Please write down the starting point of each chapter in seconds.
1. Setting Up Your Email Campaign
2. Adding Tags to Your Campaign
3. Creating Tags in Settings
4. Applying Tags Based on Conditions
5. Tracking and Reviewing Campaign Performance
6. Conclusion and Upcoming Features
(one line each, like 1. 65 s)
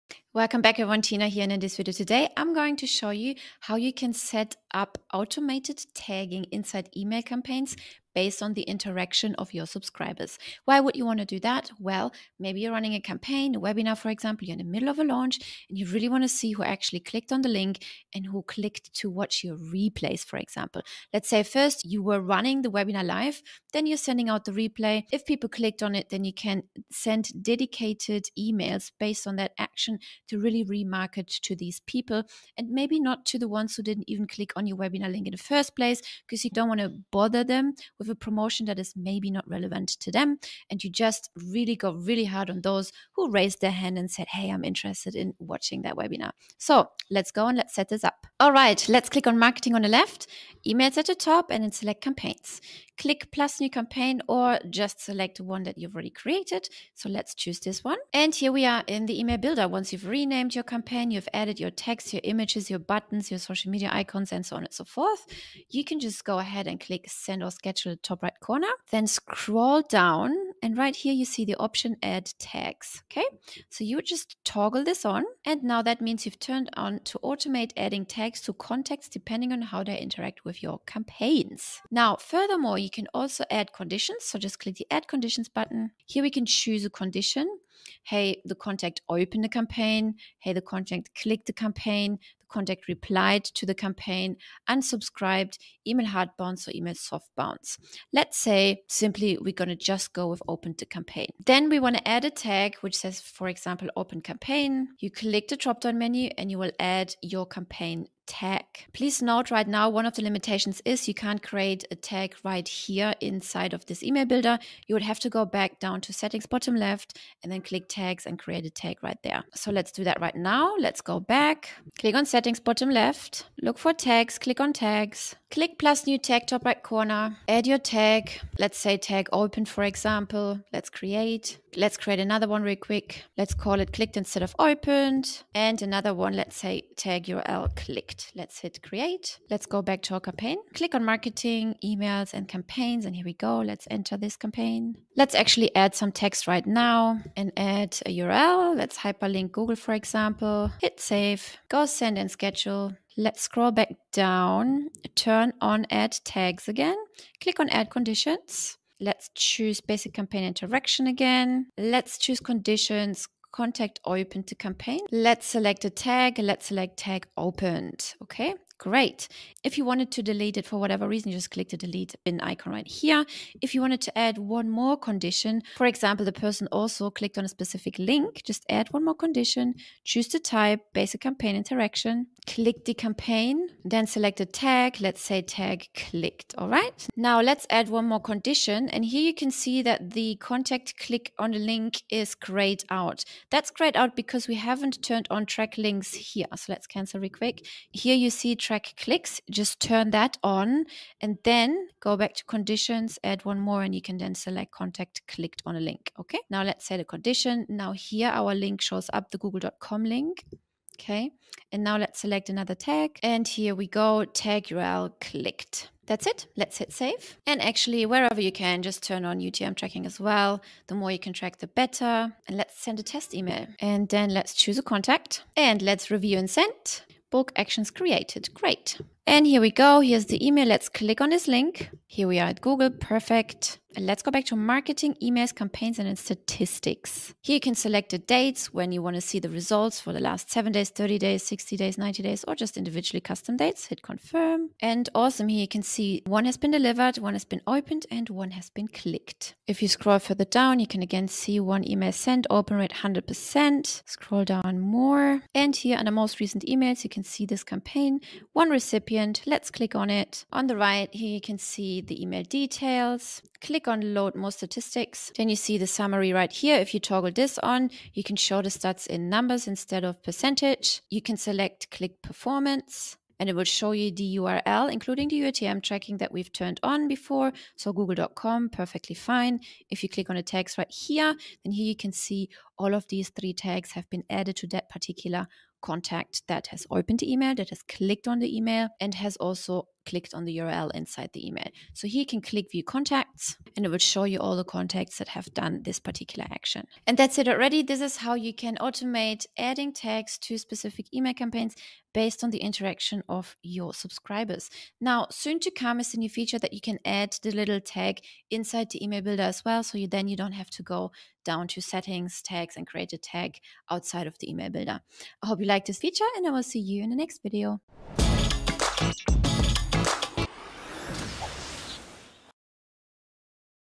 1. 48 s
2. 68 s
3. 114 s
4. 157 s
5. 233 s
6. 296 s.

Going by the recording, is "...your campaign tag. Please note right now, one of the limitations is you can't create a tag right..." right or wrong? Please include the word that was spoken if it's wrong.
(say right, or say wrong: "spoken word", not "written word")
right.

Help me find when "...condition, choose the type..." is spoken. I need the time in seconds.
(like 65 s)
179 s.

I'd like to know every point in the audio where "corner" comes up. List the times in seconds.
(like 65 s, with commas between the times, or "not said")
68 s, 126 s.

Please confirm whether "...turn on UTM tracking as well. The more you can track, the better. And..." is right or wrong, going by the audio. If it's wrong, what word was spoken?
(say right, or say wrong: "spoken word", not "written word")
right.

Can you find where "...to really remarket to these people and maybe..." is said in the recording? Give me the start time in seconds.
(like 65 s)
30 s.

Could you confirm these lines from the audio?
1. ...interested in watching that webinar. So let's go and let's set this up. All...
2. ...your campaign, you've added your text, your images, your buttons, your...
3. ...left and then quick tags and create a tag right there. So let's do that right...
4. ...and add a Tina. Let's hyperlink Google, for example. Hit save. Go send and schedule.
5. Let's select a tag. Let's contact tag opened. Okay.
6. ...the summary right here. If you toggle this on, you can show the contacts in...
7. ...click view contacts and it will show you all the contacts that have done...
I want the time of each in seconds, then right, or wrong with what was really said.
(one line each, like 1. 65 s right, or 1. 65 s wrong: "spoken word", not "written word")
1. 44 s right
2. 60 s right
3. 116 s wrong: "click", not "quick"
4. 147 s wrong: "URL", not "Tina"
5. 165 s wrong: "select", not "contact"
6. 265 s wrong: "stats", not "contacts"
7. 292 s right.